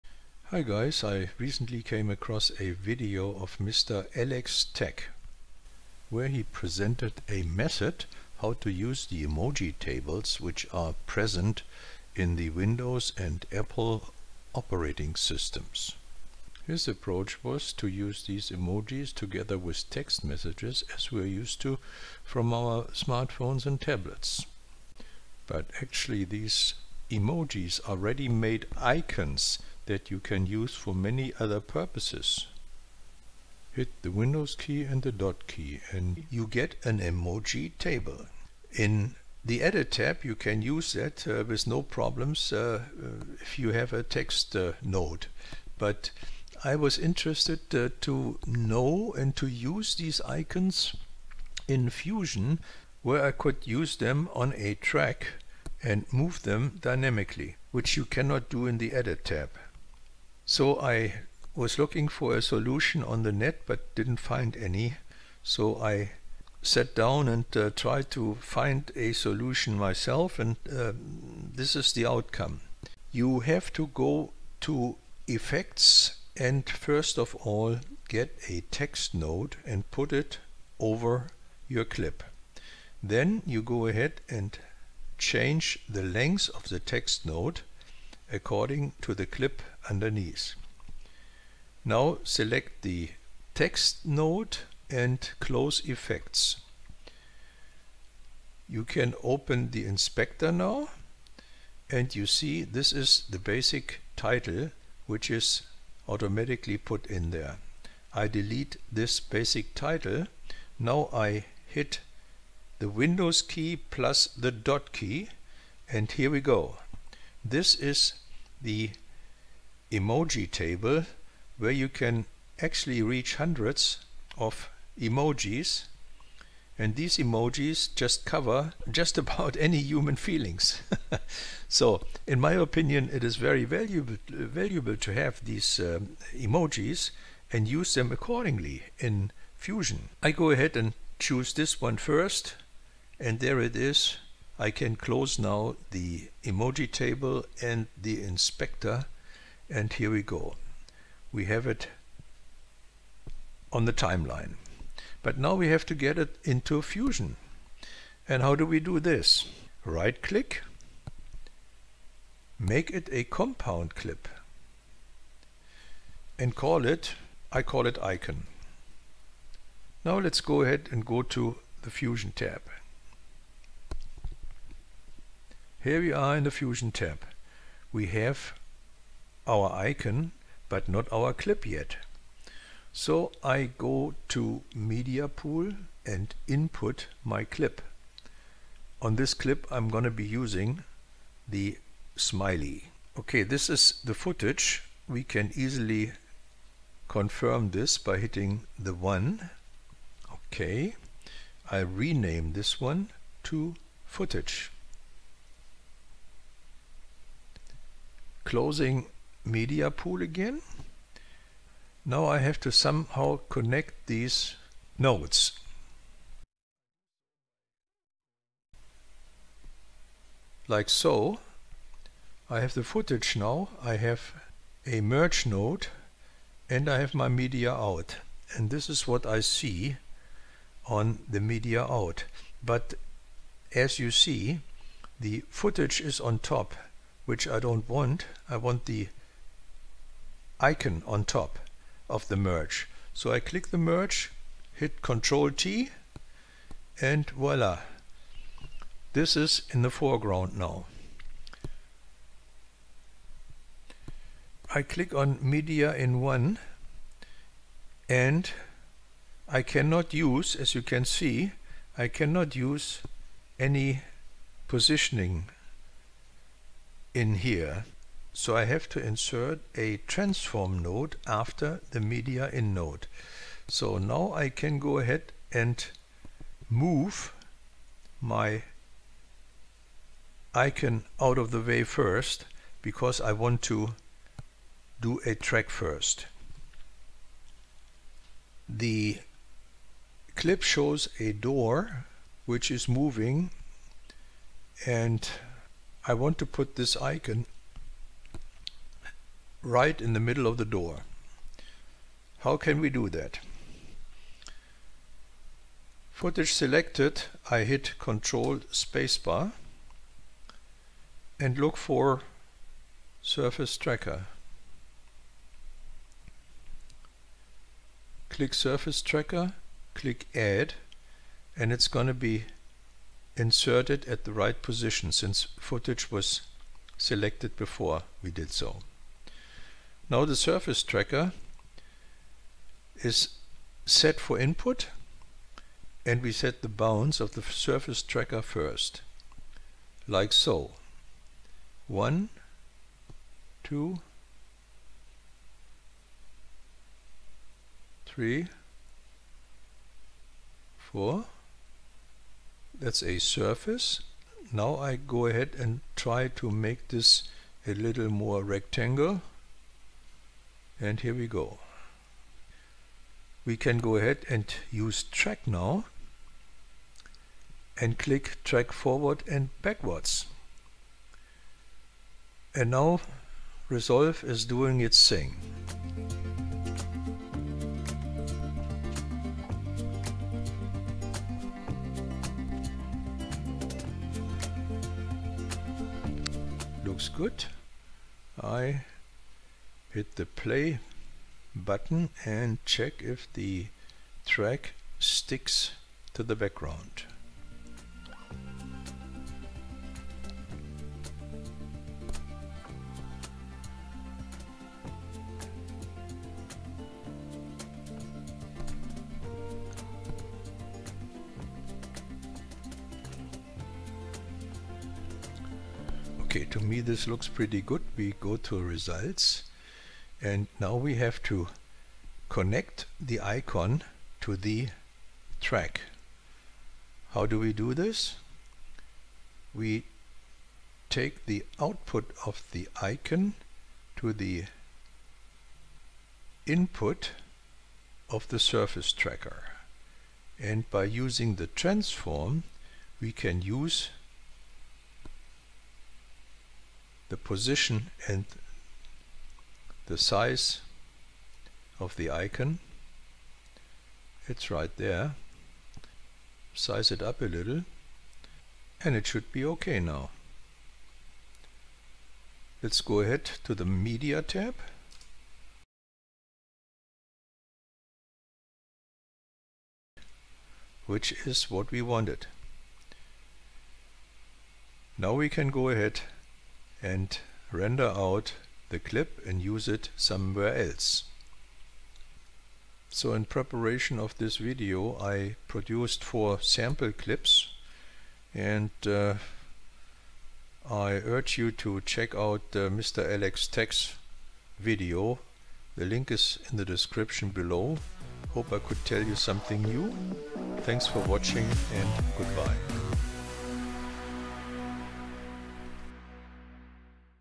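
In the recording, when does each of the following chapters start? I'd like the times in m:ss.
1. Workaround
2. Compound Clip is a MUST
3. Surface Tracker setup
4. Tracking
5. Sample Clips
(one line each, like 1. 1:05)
1. 1:12
2. 2:43
3. 5:35
4. 6:16
5. 8:02.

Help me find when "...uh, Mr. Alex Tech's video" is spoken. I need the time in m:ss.
8:12.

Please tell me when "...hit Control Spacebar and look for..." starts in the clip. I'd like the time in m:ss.
5:07.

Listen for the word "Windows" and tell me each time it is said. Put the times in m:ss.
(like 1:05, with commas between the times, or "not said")
0:12, 0:34, 1:52.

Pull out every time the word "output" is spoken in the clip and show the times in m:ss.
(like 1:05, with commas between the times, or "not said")
7:11.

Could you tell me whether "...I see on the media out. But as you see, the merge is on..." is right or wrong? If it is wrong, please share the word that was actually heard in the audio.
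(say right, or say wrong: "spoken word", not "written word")
wrong: "footage", not "merge".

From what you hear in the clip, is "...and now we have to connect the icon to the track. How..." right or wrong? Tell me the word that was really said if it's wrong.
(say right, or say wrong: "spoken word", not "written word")
right.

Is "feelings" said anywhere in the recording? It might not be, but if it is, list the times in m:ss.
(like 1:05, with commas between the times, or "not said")
2:10.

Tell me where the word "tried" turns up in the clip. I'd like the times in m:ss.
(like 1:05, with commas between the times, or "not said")
1:07.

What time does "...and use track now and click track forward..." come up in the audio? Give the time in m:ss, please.
6:04.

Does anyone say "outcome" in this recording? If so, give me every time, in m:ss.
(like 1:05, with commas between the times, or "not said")
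1:12.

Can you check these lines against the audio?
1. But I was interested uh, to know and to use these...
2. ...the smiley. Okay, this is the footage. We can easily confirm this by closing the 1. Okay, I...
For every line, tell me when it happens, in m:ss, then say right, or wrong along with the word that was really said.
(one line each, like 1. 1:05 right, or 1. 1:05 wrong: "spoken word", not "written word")
1. 0:45 right
2. 3:11 wrong: "hitting", not "closing".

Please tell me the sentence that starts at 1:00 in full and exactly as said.
So I was looking for a solution on the net but didn't find any.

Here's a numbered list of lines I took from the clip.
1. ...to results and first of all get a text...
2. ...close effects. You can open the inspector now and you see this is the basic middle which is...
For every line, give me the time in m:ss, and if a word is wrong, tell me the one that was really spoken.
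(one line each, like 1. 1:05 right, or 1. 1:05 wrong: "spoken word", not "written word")
1. 1:14 wrong: "effects", not "results"
2. 1:35 wrong: "title", not "middle".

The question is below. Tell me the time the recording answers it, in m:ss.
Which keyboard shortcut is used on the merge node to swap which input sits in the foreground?
4:05.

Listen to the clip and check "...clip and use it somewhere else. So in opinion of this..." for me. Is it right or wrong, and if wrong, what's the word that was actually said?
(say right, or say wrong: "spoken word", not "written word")
wrong: "preparation", not "opinion".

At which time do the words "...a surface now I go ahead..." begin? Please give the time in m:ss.
5:53.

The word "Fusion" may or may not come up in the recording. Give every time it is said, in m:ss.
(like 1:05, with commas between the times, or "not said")
0:51, 2:19, 2:36, 2:51, 2:56.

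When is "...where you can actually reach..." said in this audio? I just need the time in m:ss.
2:01.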